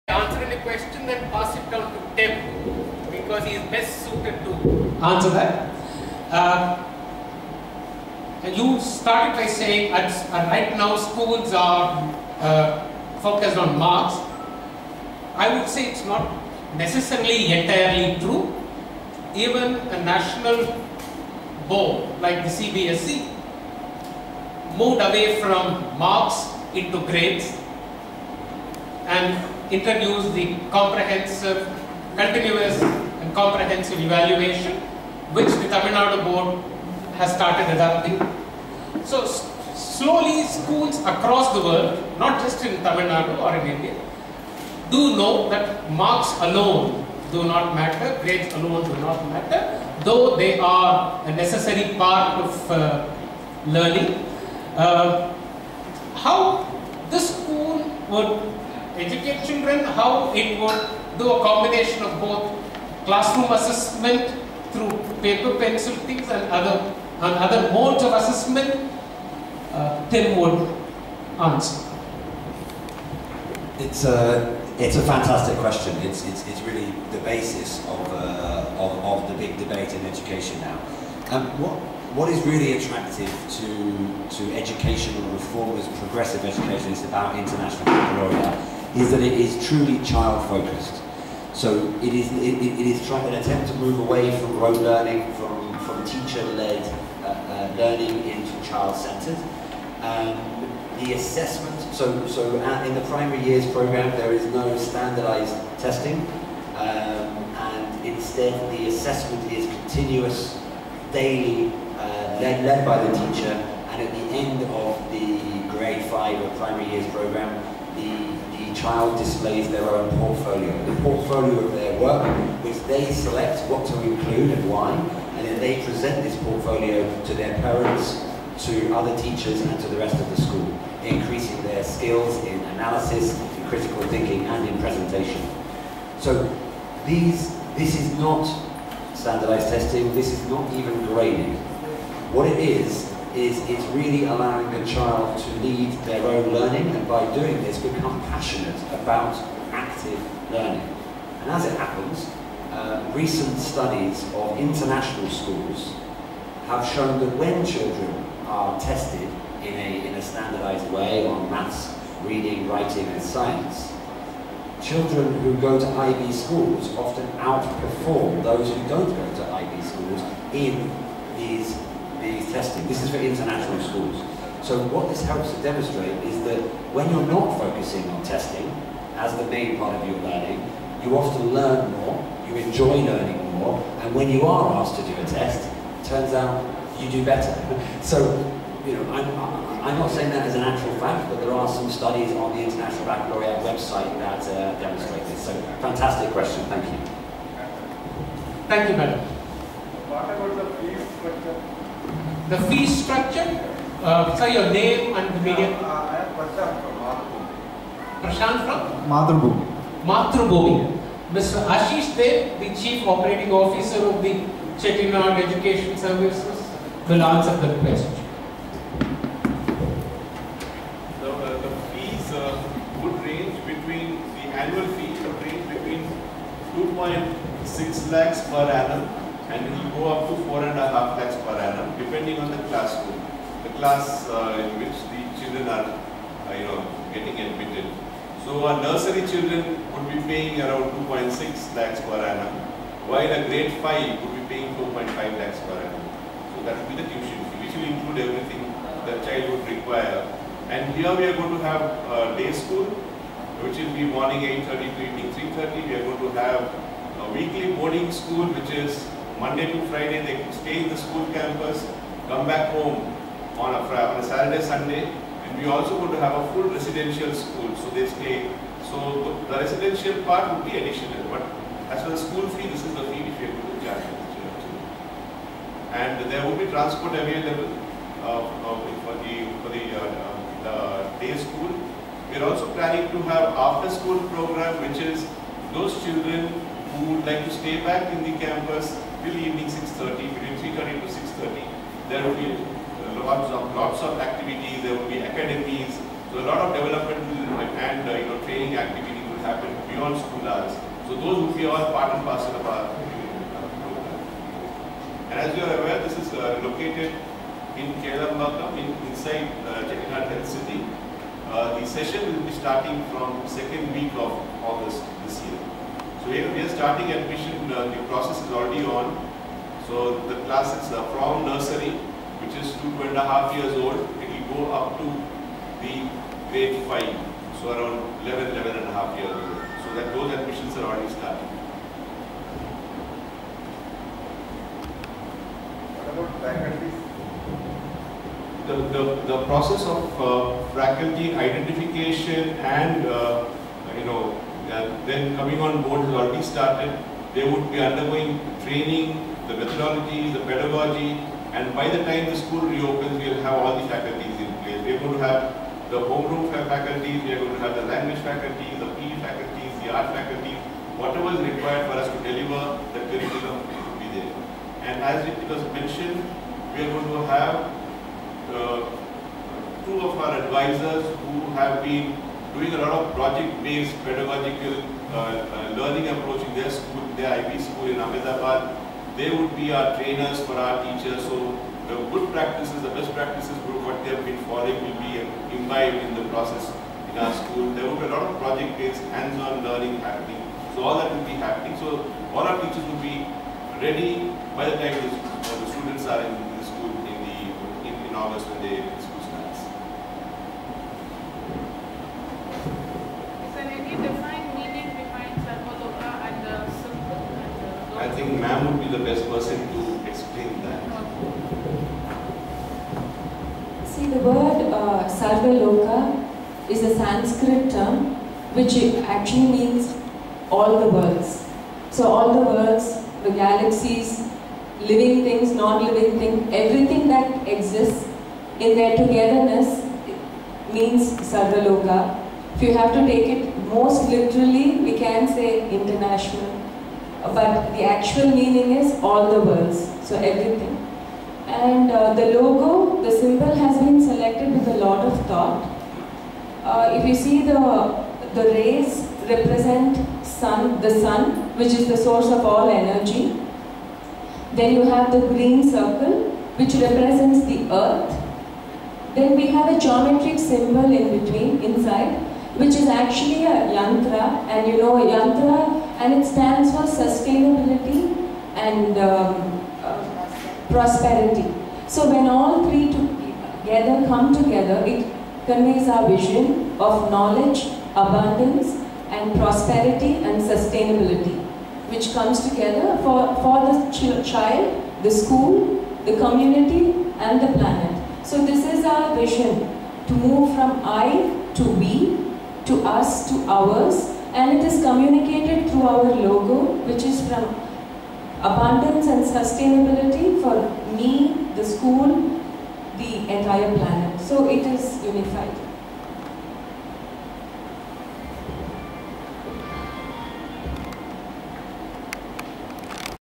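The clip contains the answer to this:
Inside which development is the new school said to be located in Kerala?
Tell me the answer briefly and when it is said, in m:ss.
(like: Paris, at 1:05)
Health City, at 5:09.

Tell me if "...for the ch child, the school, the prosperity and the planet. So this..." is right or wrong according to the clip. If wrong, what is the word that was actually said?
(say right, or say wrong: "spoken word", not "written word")
wrong: "community", not "prosperity".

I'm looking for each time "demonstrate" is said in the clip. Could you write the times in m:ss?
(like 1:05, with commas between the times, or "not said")
2:55, 3:14.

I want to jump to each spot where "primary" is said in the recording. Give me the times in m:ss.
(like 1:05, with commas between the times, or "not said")
1:43, 1:56.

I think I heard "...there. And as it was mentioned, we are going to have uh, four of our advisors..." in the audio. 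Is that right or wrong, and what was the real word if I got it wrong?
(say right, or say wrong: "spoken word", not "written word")
wrong: "two", not "four".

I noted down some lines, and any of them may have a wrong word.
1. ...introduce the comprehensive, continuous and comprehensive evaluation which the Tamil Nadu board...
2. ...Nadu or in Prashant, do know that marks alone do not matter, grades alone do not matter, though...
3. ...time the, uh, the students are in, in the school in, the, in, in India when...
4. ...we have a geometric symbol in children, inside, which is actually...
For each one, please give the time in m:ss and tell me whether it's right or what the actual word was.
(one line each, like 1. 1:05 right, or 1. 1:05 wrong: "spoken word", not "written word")
1. 0:29 right
2. 0:43 wrong: "India", not "Prashant"
3. 6:34 wrong: "August", not "India"
4. 7:39 wrong: "between", not "children".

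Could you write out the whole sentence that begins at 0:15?
I would say it's not necessarily entirely true.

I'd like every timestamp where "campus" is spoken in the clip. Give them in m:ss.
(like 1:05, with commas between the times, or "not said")
4:21, 4:48.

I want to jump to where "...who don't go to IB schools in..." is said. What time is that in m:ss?
2:48.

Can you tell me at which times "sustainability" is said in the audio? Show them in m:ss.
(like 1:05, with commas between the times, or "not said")
7:47, 8:00, 8:19.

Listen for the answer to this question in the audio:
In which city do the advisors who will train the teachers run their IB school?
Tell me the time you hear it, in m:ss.
6:17.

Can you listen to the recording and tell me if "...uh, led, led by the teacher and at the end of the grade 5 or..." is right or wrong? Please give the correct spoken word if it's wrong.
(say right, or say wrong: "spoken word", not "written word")
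right.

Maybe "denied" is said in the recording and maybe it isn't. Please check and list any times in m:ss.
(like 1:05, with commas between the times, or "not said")
not said.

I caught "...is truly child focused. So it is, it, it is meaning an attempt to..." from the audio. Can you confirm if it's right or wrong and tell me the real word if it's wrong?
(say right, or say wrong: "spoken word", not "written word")
wrong: "trying", not "meaning".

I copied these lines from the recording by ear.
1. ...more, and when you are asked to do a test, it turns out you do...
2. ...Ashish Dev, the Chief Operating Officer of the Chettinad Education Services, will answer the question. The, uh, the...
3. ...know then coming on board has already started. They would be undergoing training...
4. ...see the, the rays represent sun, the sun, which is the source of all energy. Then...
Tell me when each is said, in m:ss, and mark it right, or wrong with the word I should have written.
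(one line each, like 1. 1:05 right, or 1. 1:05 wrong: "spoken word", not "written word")
1. 3:03 right
2. 3:31 right
3. 5:44 right
4. 7:27 right.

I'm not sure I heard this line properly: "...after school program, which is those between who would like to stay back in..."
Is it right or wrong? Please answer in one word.
wrong.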